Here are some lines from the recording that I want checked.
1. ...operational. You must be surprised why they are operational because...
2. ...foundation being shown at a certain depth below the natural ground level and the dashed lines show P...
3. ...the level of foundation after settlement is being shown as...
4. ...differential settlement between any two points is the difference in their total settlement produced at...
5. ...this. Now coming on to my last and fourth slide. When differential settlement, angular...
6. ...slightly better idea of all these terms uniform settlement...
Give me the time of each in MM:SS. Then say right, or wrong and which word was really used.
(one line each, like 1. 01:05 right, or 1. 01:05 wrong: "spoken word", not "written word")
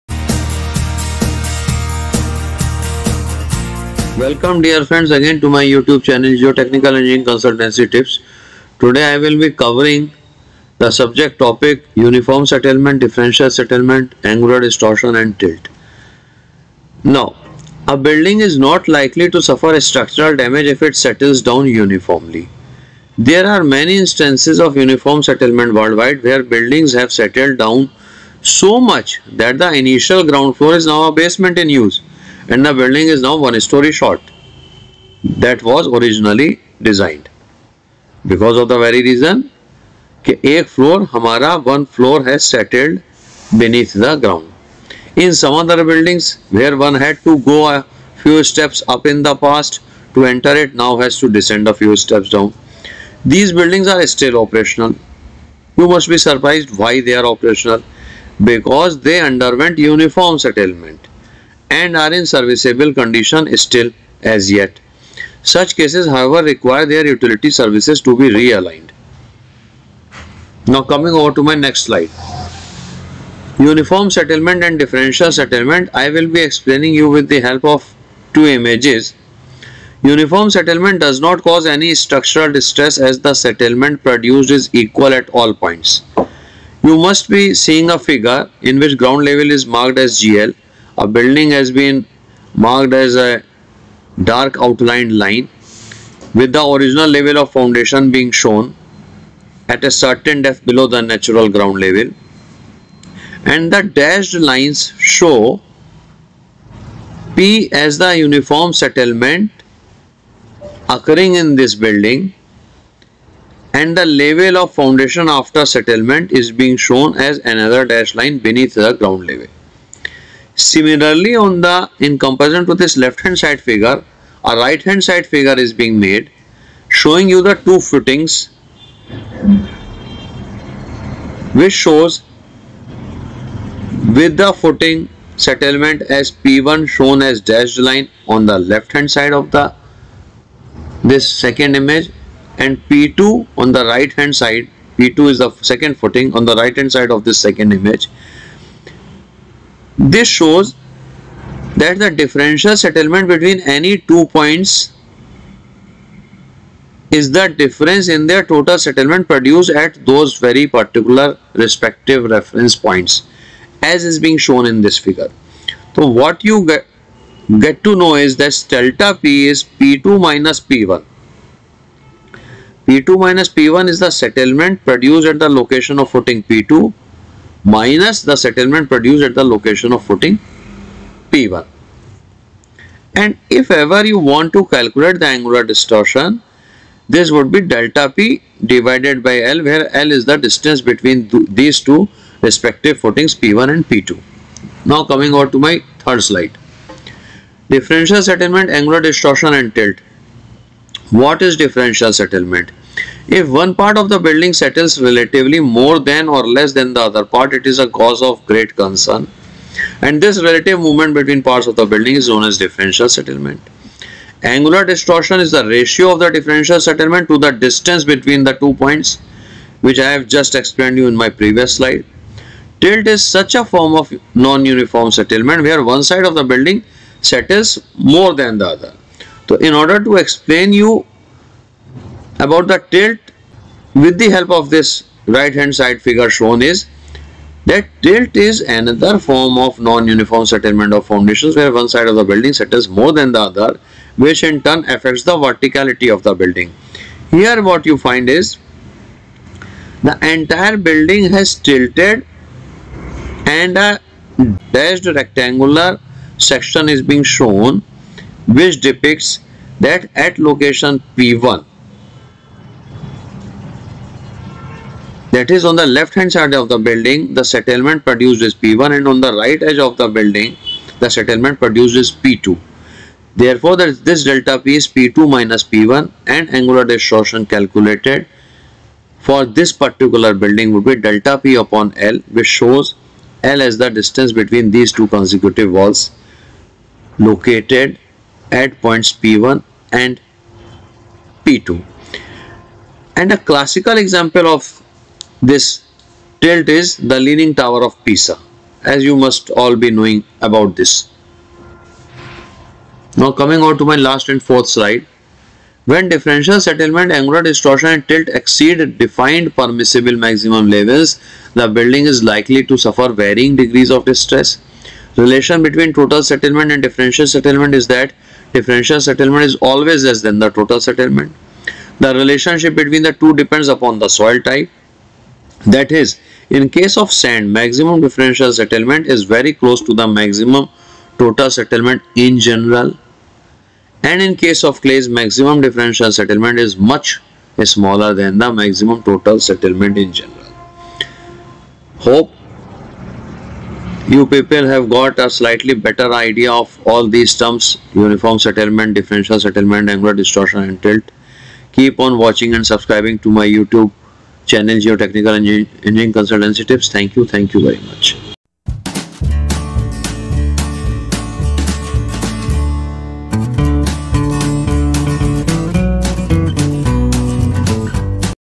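1. 00:54 right
2. 01:37 right
3. 01:53 right
4. 02:32 right
5. 05:00 right
6. 05:45 right.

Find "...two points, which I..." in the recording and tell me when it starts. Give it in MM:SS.
03:38.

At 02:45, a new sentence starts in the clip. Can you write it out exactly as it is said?
So what you get, get to know is that delta P is P2 minus P1.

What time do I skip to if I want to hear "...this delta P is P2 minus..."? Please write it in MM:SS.
04:33.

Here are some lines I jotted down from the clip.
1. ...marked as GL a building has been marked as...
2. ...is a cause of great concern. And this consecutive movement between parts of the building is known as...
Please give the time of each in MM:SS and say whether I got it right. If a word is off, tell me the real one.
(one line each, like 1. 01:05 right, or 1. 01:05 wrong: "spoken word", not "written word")
1. 01:29 right
2. 03:27 wrong: "relative", not "consecutive".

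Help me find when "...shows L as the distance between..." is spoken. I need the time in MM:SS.
04:42.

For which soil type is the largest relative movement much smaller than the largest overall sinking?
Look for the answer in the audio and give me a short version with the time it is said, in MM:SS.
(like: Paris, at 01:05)
Clays, at 05:34.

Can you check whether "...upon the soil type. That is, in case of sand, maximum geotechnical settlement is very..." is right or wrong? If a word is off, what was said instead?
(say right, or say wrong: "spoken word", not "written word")
wrong: "differential", not "geotechnical".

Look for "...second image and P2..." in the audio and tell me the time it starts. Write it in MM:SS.
02:21.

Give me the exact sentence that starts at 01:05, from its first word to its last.
Such cases however require their utility services to be realigned.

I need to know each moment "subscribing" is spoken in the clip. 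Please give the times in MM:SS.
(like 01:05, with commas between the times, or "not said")
05:52.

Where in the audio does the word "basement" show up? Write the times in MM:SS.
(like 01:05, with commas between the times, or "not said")
00:31.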